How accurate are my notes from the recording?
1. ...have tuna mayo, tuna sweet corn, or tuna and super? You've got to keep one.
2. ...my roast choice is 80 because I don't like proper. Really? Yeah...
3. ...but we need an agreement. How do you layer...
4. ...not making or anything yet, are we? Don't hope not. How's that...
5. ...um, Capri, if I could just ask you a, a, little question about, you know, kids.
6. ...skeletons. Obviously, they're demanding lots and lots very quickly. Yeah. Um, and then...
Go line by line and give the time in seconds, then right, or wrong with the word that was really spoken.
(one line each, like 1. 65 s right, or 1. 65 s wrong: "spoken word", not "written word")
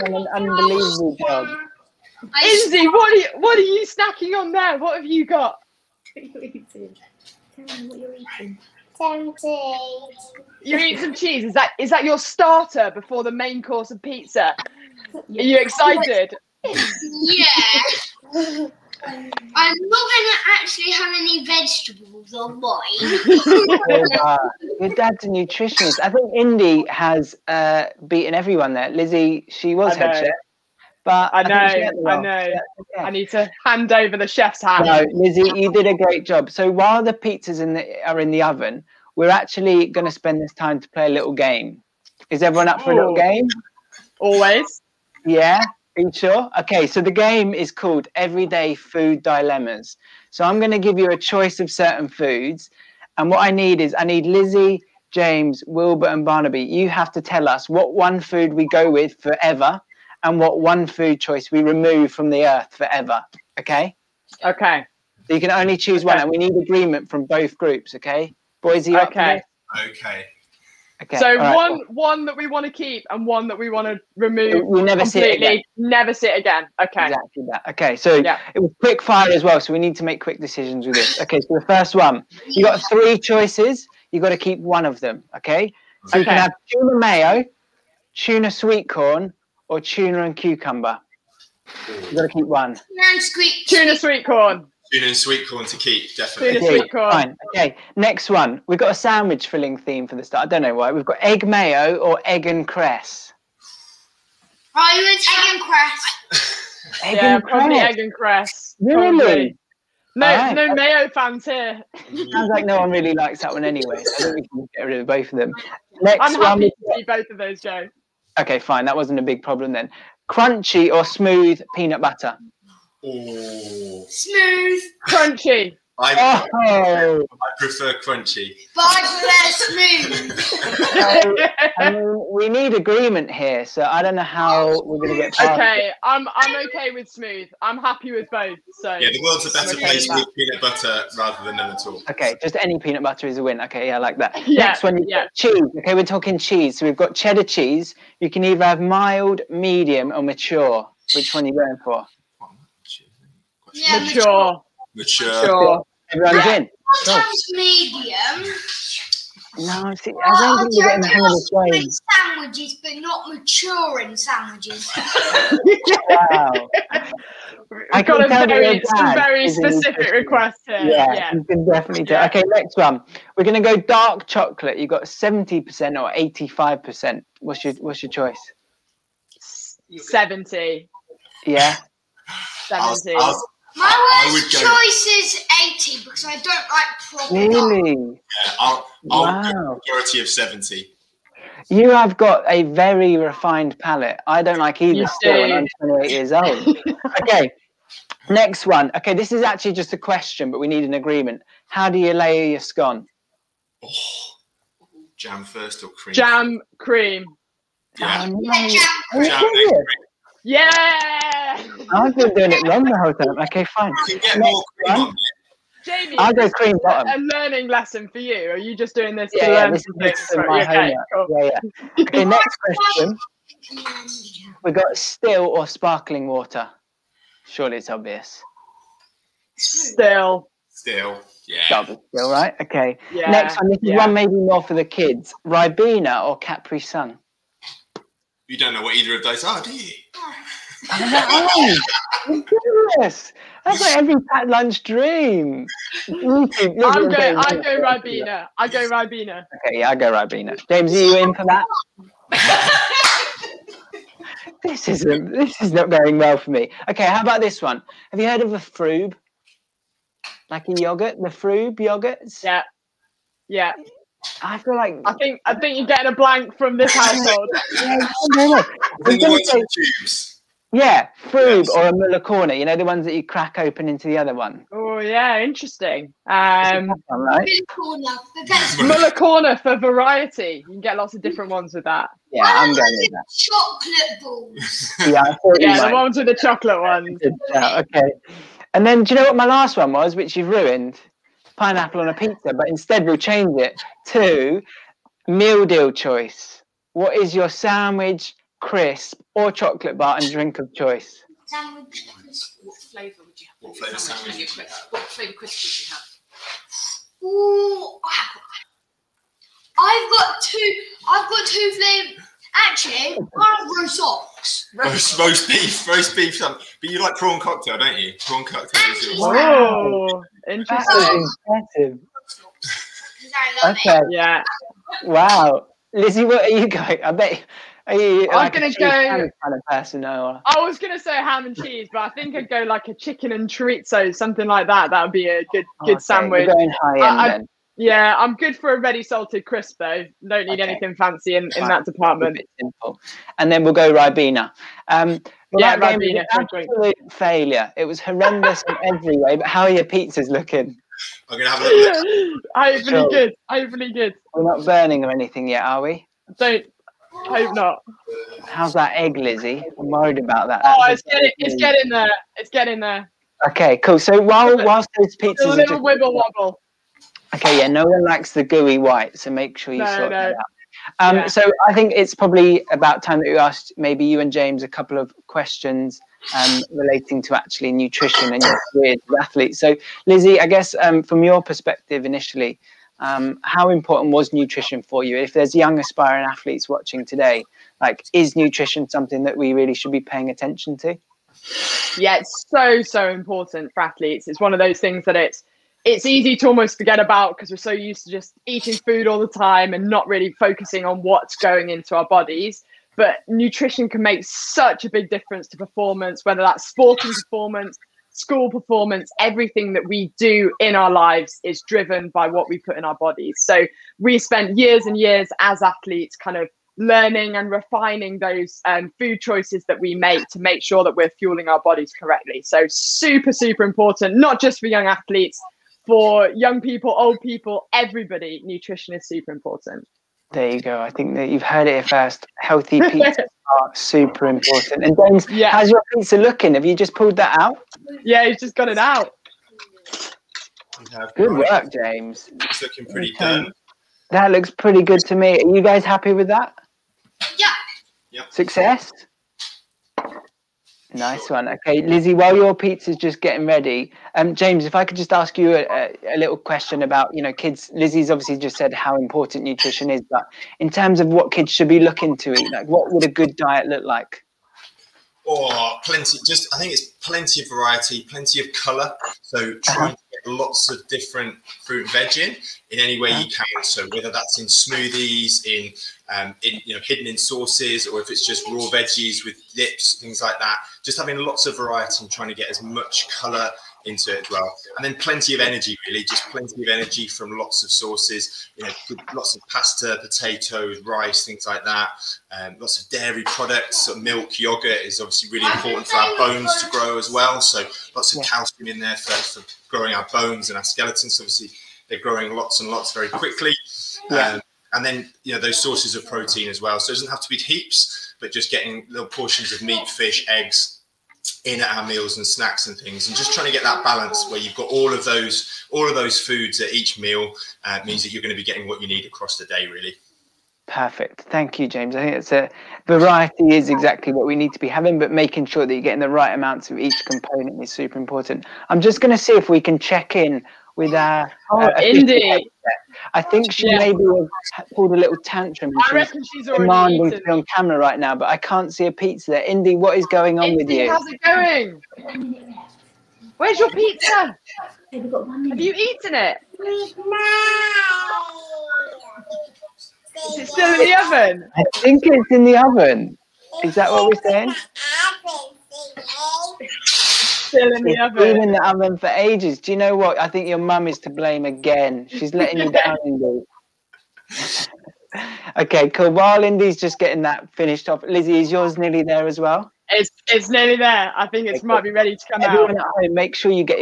1. 86 s wrong: "cucumber", not "super"
2. 183 s wrong: "worst", not "roast"
3. 200 s right
4. 354 s wrong: "burning", not "making"
5. 454 s wrong: "James", not "Capri"
6. 500 s wrong: "growing", not "demanding".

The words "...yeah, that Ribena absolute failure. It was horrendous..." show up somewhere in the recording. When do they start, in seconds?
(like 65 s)
345 s.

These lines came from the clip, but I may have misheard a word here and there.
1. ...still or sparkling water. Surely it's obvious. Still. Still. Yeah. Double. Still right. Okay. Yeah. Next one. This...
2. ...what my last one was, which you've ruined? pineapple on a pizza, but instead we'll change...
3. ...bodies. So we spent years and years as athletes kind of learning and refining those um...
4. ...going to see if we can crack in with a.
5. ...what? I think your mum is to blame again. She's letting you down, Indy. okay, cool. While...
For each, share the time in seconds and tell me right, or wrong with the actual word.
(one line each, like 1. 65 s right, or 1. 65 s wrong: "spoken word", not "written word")
1. 224 s right
2. 289 s right
3. 412 s right
4. 528 s wrong: "check", not "crack"
5. 559 s right.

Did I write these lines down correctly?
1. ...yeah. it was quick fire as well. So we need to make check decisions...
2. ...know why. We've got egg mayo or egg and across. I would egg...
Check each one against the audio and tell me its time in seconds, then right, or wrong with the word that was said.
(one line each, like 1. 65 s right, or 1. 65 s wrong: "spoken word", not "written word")
1. 78 s wrong: "quick", not "check"
2. 100 s wrong: "cress", not "across".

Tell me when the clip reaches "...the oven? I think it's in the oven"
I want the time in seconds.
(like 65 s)
550 s.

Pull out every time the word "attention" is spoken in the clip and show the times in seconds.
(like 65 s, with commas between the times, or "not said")
390 s.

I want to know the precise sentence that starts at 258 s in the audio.
Have you heard of a Frube?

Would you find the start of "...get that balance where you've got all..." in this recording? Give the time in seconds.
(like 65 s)
513 s.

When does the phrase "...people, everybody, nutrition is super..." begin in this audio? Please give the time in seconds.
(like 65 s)
427 s.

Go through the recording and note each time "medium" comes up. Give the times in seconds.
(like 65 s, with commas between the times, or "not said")
149 s, 157 s.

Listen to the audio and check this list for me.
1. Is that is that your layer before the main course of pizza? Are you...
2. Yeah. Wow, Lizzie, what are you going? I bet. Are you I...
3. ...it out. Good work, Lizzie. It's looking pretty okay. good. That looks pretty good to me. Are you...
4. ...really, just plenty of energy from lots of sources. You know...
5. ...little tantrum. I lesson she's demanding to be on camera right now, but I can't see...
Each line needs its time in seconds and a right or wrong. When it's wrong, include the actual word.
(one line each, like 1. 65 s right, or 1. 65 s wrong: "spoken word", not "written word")
1. 11 s wrong: "starter", not "layer"
2. 324 s right
3. 438 s wrong: "James", not "Lizzie"
4. 485 s right
5. 534 s wrong: "reckon", not "lesson".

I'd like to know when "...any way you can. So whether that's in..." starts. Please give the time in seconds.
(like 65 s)
472 s.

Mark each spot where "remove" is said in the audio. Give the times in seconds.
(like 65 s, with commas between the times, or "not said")
61 s, 74 s.